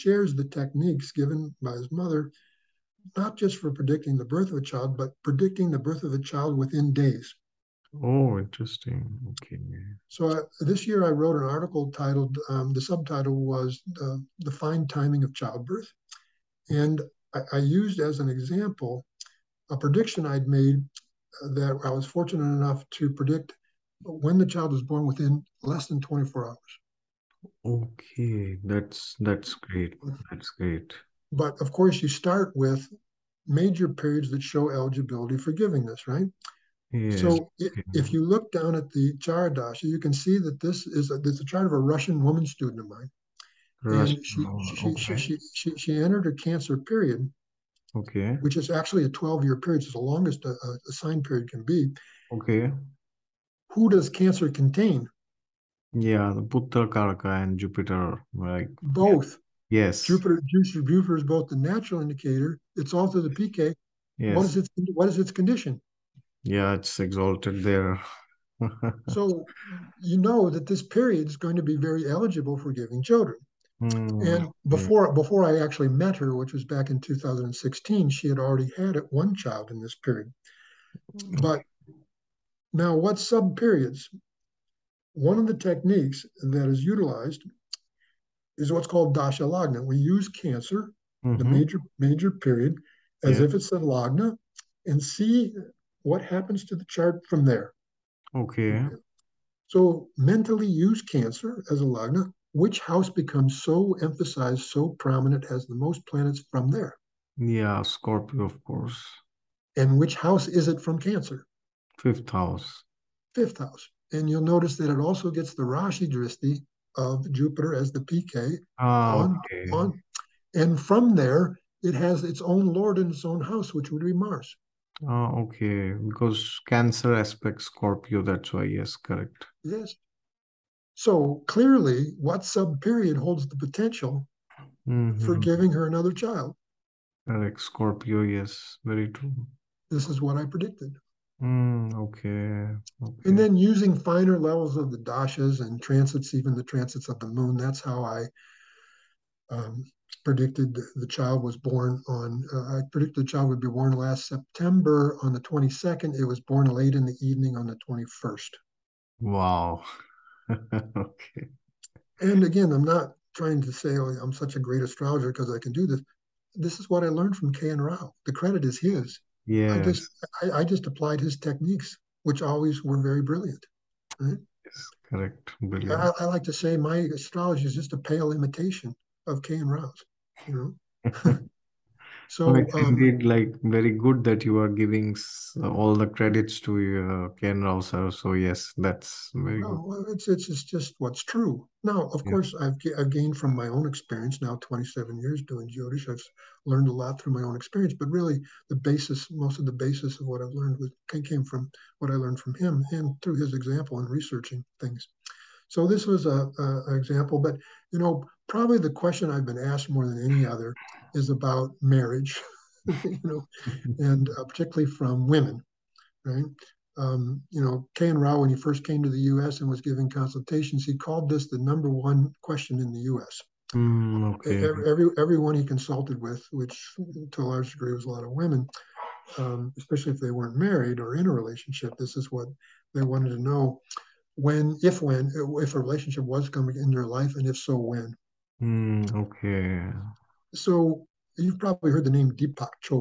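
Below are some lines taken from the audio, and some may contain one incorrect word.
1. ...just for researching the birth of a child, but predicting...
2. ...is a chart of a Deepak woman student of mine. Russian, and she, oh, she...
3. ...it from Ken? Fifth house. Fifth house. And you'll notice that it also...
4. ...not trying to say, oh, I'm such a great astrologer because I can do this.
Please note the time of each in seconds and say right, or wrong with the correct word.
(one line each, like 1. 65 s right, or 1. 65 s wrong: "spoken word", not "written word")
1. 3 s wrong: "predicting", not "researching"
2. 41 s wrong: "Russian", not "Deepak"
3. 110 s wrong: "Cancer", not "Ken"
4. 162 s right.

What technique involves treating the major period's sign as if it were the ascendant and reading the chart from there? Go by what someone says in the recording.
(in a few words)
Dasha lagna.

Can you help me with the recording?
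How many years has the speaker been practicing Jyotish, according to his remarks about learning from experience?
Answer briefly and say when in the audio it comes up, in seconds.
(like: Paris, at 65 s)
27, at 194 s.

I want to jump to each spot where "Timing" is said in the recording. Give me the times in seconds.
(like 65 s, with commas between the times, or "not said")
14 s.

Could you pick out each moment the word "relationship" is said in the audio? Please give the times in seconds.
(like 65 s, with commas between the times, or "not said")
231 s, 235 s.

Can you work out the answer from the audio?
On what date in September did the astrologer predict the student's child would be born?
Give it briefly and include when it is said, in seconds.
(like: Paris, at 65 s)
22nd, at 155 s.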